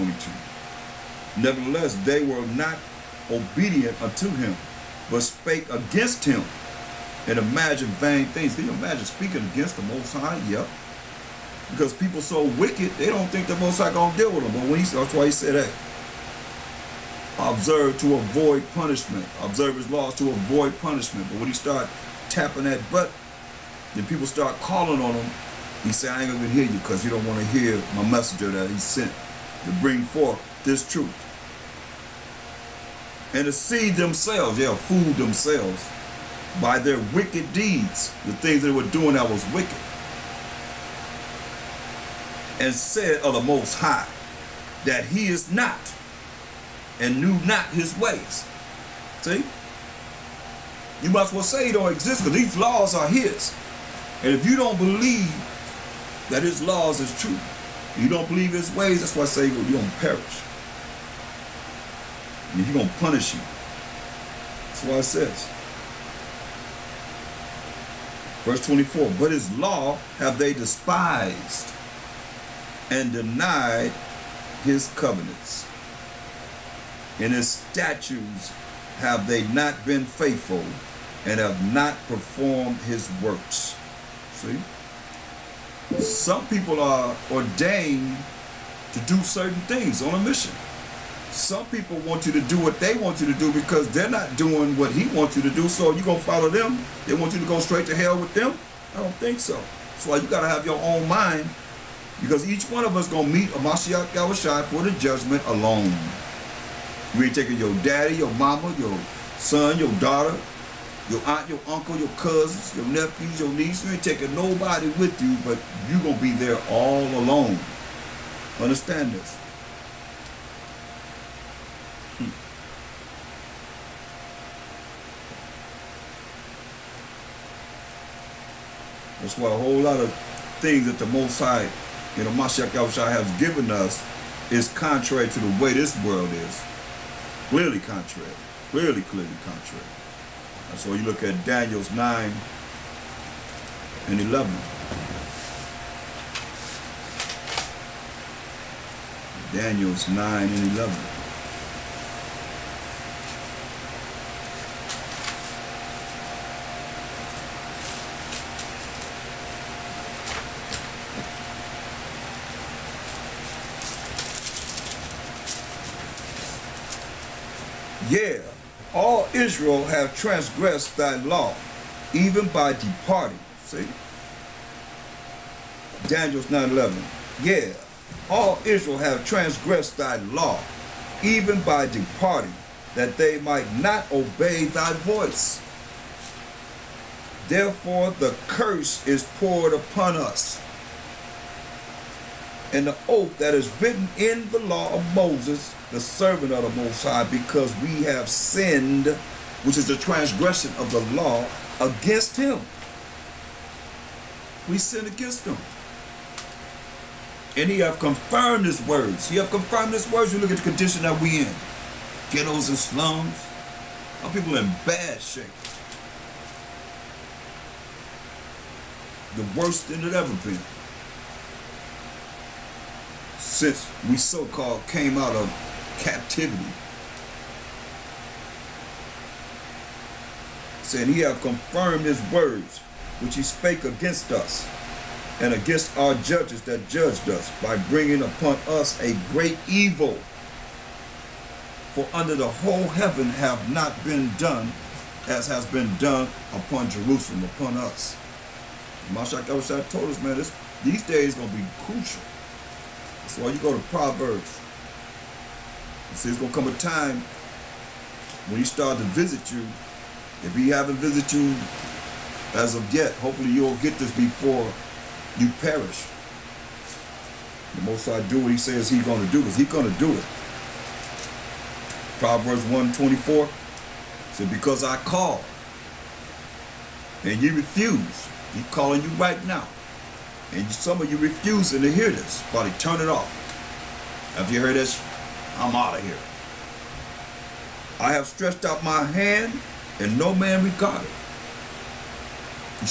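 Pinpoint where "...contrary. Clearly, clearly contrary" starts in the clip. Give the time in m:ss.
2:17.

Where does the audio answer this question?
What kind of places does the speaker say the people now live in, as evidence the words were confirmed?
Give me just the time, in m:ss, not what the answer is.
3:32.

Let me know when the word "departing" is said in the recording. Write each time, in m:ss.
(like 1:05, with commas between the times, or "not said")
2:52, 3:01.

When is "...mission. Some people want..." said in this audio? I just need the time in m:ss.
1:30.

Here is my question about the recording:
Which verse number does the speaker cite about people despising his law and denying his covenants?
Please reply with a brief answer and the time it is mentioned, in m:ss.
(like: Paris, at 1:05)
24, at 1:08.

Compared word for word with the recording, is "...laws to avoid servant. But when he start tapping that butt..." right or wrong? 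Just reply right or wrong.
wrong.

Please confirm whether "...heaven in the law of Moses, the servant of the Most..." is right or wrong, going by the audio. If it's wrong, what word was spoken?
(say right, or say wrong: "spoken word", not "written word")
wrong: "written", not "heaven".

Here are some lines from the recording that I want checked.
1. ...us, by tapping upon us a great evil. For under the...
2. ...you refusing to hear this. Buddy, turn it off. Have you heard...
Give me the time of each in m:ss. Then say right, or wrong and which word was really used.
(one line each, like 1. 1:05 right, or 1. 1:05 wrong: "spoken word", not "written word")
1. 3:57 wrong: "bringing", not "tapping"
2. 4:41 right.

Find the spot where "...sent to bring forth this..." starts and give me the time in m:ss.
0:28.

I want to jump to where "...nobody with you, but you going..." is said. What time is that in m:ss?
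1:54.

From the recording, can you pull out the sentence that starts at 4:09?
Mashak Elshad told us, man, this, these days going to be crucial.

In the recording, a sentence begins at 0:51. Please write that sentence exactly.
You might as well say he don't exist because these laws are his.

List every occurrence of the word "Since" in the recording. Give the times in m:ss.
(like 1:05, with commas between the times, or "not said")
3:43.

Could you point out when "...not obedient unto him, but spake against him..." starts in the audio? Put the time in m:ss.
0:02.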